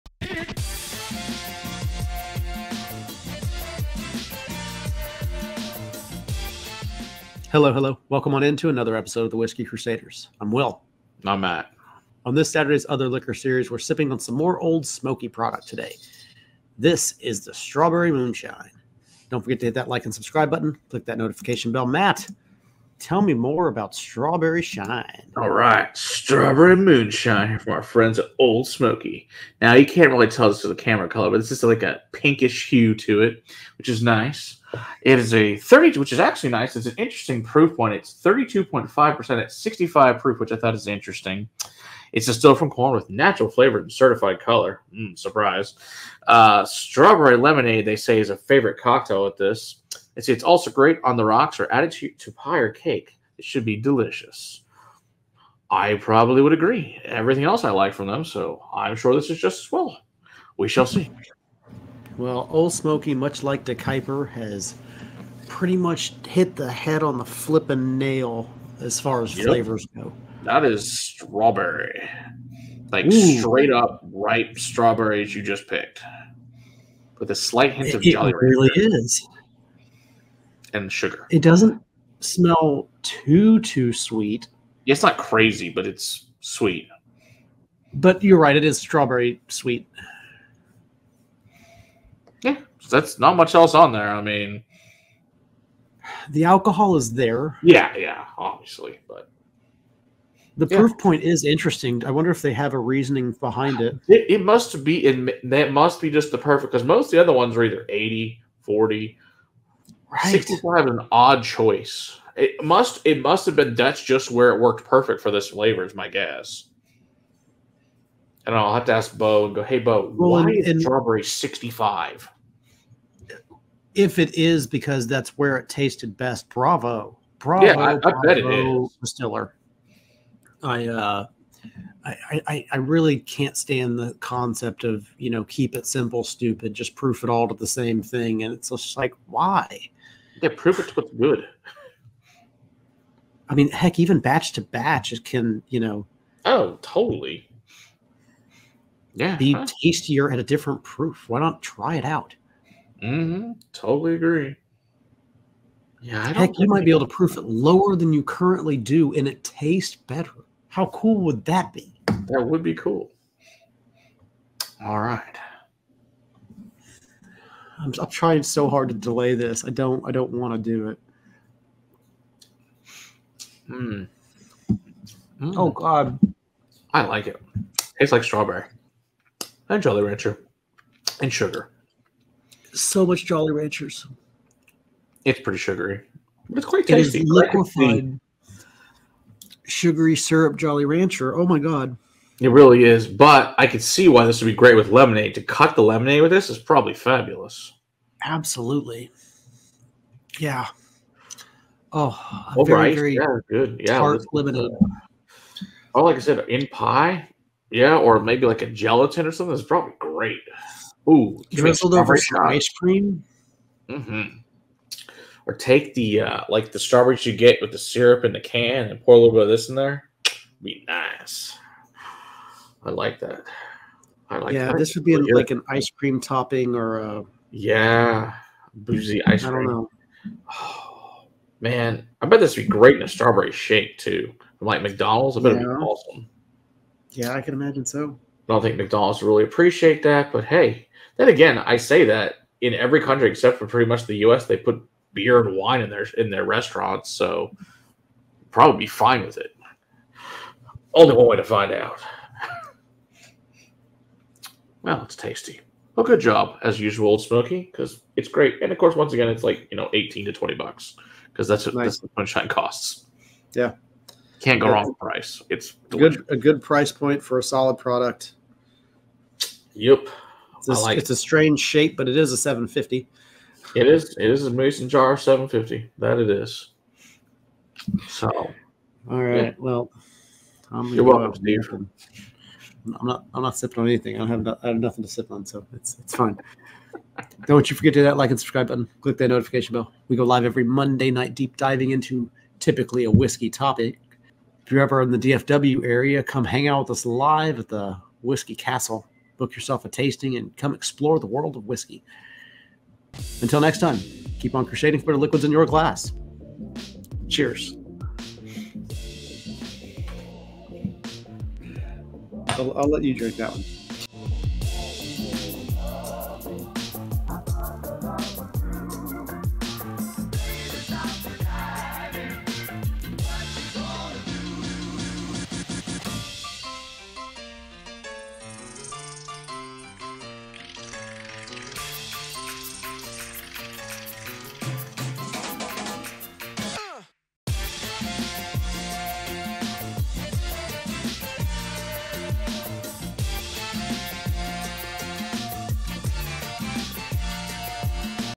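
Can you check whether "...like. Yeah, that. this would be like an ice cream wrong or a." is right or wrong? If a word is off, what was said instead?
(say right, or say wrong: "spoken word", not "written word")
wrong: "topping", not "wrong".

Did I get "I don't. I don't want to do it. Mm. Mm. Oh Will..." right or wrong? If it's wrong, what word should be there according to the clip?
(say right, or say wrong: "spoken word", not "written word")
wrong: "God", not "Will".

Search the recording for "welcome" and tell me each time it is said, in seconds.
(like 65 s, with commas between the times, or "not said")
8 s, 281 s.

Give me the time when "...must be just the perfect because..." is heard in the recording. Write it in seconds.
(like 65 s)
105 s.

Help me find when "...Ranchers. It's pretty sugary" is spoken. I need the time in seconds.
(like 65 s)
183 s.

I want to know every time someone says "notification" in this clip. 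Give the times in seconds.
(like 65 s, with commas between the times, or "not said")
21 s, 289 s.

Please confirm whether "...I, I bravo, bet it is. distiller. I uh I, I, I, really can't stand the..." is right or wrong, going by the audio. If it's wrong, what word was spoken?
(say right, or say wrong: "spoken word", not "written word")
right.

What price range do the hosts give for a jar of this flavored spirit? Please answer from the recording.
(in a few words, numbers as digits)
$18 to $20.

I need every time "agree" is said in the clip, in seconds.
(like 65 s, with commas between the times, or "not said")
56 s, 154 s.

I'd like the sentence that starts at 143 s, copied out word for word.
I mean, heck, even batch to batch it can, you know.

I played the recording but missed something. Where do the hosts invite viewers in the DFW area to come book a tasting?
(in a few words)
Whiskey Castle.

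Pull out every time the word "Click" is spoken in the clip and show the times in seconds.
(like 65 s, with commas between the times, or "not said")
20 s, 289 s.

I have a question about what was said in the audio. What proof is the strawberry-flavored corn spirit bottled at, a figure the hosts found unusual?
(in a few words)
65 proof.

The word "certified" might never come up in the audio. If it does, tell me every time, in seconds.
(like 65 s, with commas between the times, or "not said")
43 s.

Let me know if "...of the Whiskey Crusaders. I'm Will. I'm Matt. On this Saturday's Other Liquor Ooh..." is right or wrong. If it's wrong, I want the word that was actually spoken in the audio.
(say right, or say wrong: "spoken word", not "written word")
wrong: "Series", not "Ooh".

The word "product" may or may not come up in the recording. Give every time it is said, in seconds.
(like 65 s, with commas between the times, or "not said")
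15 s, 267 s.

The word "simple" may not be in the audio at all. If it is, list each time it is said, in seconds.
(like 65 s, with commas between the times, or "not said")
135 s.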